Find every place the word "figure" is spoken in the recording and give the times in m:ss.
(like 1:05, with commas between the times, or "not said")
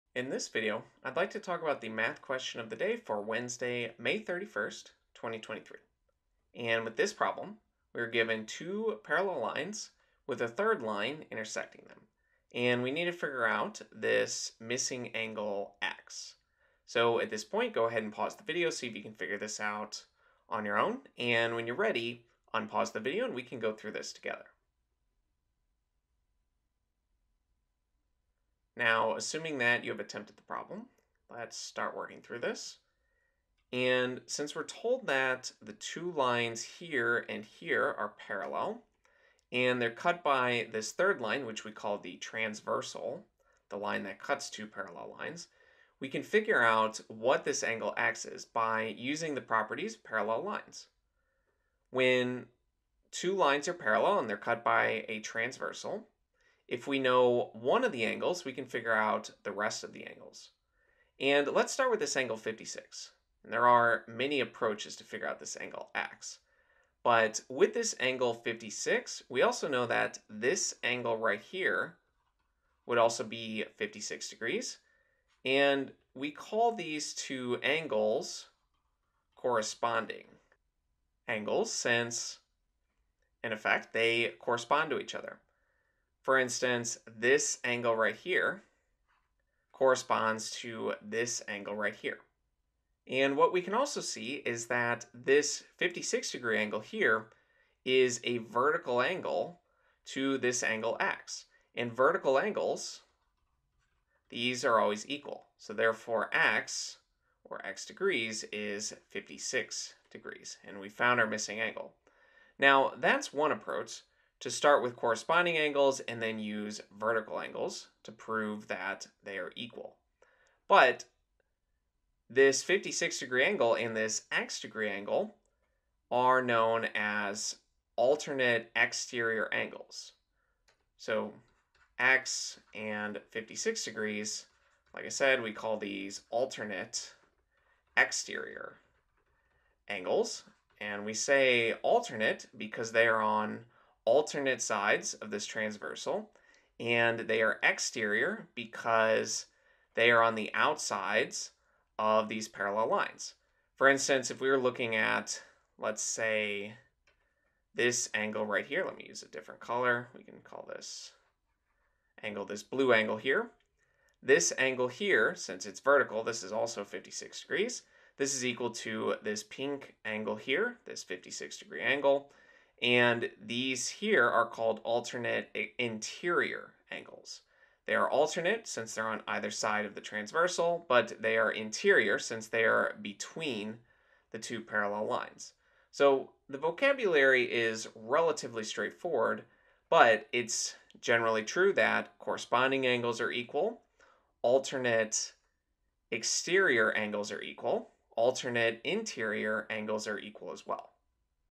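0:13, 0:19, 0:46, 0:58, 1:05.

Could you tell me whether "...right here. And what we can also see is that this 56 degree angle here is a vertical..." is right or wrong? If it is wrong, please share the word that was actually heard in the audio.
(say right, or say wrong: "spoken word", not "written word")
right.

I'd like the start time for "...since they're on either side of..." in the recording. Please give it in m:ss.
2:58.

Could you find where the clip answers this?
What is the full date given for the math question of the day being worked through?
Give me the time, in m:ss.
0:03.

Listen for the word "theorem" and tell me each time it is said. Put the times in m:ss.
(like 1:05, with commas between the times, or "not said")
not said.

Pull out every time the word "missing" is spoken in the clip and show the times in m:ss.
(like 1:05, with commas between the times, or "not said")
0:14, 1:51.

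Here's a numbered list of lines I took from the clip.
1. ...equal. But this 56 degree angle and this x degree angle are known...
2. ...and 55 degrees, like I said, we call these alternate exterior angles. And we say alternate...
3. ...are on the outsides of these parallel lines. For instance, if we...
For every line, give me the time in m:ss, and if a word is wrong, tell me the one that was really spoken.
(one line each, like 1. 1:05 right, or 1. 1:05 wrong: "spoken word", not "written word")
1. 1:59 right
2. 2:12 wrong: "56", not "55"
3. 2:30 right.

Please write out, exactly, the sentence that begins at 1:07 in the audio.
But with this angle 56, we also know that this angle right here would also be 56 degrees.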